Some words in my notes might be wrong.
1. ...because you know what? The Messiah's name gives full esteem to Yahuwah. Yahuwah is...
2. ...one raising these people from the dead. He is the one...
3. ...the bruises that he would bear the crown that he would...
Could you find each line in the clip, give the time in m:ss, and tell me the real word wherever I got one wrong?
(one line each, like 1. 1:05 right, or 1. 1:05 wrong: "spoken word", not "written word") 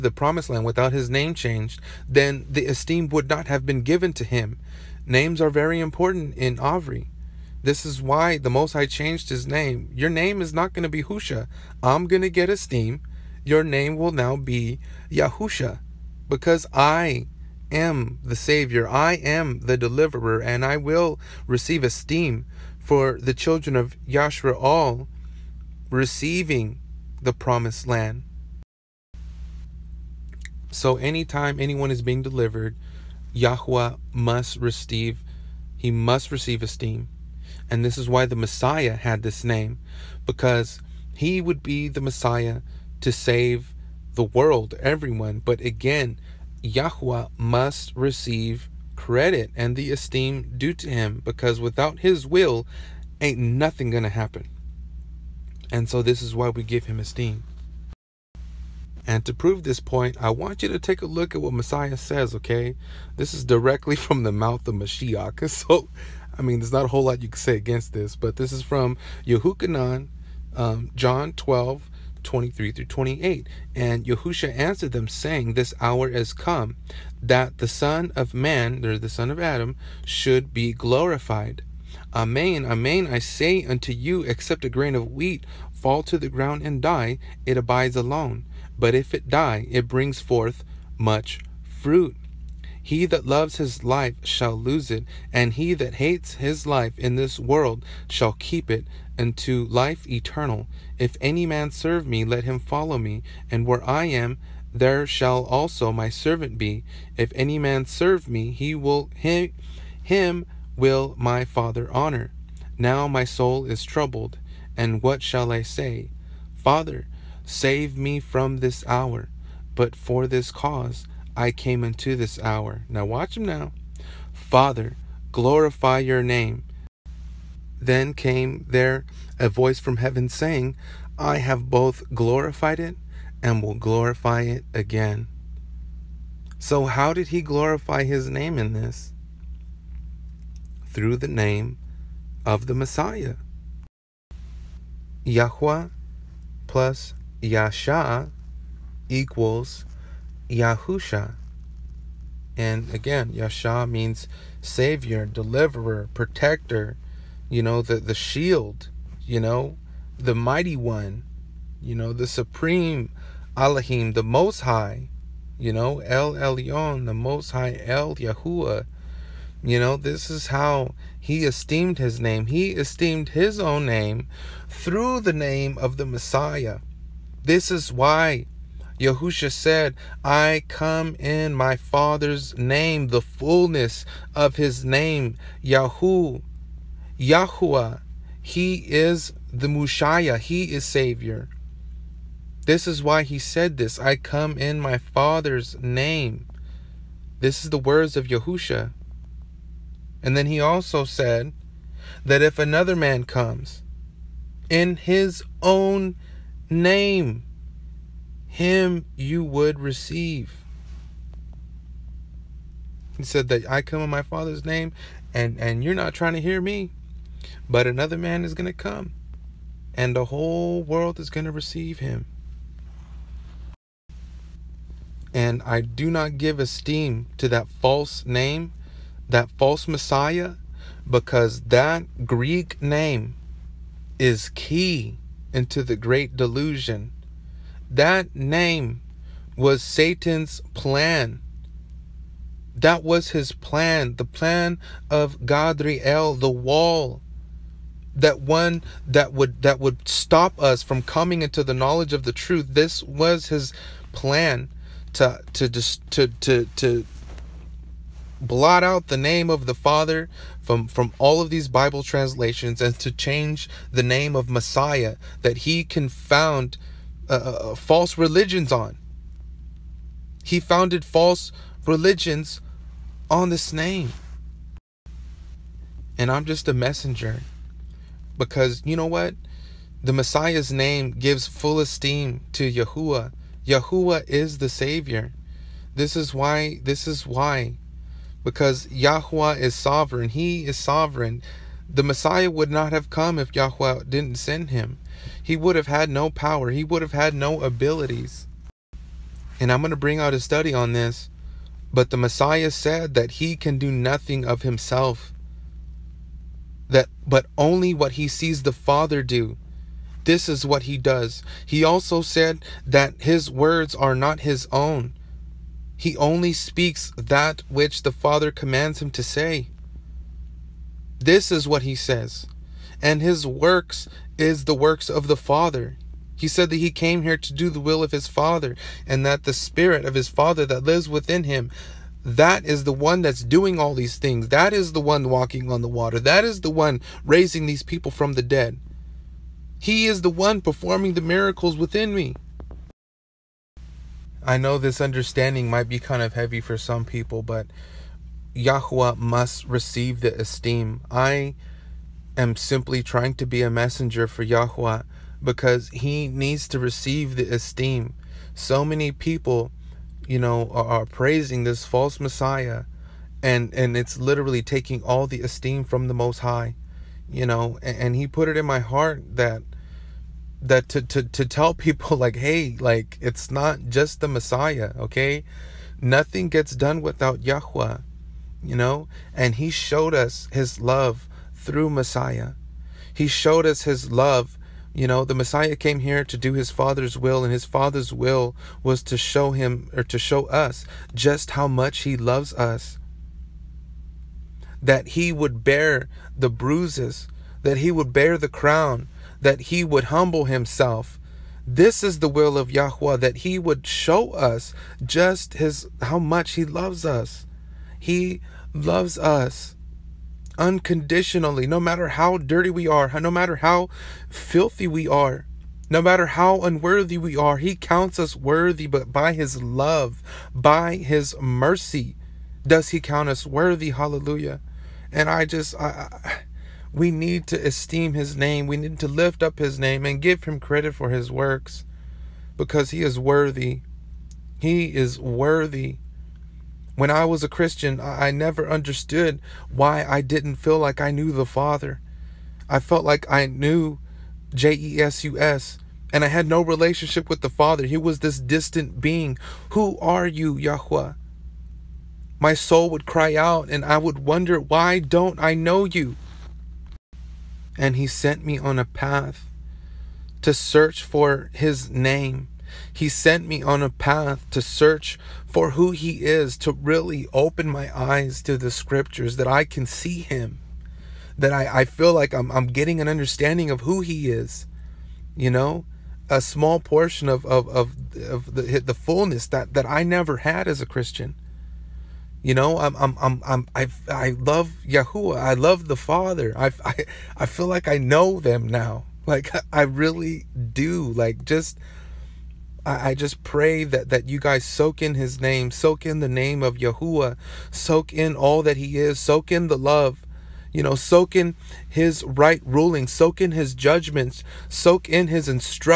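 1. 4:38 right
2. 5:36 right
3. 6:36 right.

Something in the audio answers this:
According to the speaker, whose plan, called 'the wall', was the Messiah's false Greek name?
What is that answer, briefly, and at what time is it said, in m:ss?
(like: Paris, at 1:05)
Gadriel, at 4:05.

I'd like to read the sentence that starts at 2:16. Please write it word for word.
So, how did he glorify his name in this?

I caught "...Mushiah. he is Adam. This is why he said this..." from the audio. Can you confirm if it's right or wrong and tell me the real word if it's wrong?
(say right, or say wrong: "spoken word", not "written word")
wrong: "Savior", not "Adam".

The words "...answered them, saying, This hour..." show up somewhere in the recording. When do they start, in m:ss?
1:14.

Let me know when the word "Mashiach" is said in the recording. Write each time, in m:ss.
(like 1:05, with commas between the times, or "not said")
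1:04.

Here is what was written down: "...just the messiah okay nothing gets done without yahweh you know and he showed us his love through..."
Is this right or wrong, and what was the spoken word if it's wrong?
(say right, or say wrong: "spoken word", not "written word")
right.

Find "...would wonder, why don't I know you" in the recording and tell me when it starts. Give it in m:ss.
7:33.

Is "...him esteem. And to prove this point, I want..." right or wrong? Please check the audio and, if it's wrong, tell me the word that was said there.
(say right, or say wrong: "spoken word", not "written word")
right.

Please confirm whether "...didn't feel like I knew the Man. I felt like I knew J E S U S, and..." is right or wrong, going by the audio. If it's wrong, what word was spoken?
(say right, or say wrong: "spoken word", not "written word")
wrong: "Father", not "Man".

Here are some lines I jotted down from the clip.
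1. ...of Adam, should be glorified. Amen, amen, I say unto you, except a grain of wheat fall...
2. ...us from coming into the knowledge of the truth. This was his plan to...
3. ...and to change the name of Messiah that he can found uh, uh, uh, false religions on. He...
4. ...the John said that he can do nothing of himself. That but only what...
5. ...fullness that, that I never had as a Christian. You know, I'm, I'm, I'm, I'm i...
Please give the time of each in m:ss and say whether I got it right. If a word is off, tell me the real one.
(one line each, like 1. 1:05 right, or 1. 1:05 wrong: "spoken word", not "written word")
1. 1:19 right
2. 4:10 right
3. 4:22 right
4. 5:02 wrong: "Messiah", not "John"
5. 7:58 right.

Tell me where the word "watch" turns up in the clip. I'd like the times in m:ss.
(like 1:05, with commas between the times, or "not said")
2:03.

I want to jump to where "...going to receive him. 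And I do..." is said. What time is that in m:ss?
3:41.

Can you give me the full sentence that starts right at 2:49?
You know, this is how he esteemed his name.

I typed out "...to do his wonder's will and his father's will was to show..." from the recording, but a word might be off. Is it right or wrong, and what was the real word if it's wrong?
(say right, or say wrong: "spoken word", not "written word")
wrong: "father", not "wonder".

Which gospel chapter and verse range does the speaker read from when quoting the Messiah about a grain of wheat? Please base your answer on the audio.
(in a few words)
John 12:23-28.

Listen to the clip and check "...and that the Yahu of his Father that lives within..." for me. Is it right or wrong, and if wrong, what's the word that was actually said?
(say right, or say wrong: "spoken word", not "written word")
wrong: "Spirit", not "Yahu".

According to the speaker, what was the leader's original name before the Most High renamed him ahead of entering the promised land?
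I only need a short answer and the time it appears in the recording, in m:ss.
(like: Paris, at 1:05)
Husha, at 0:11.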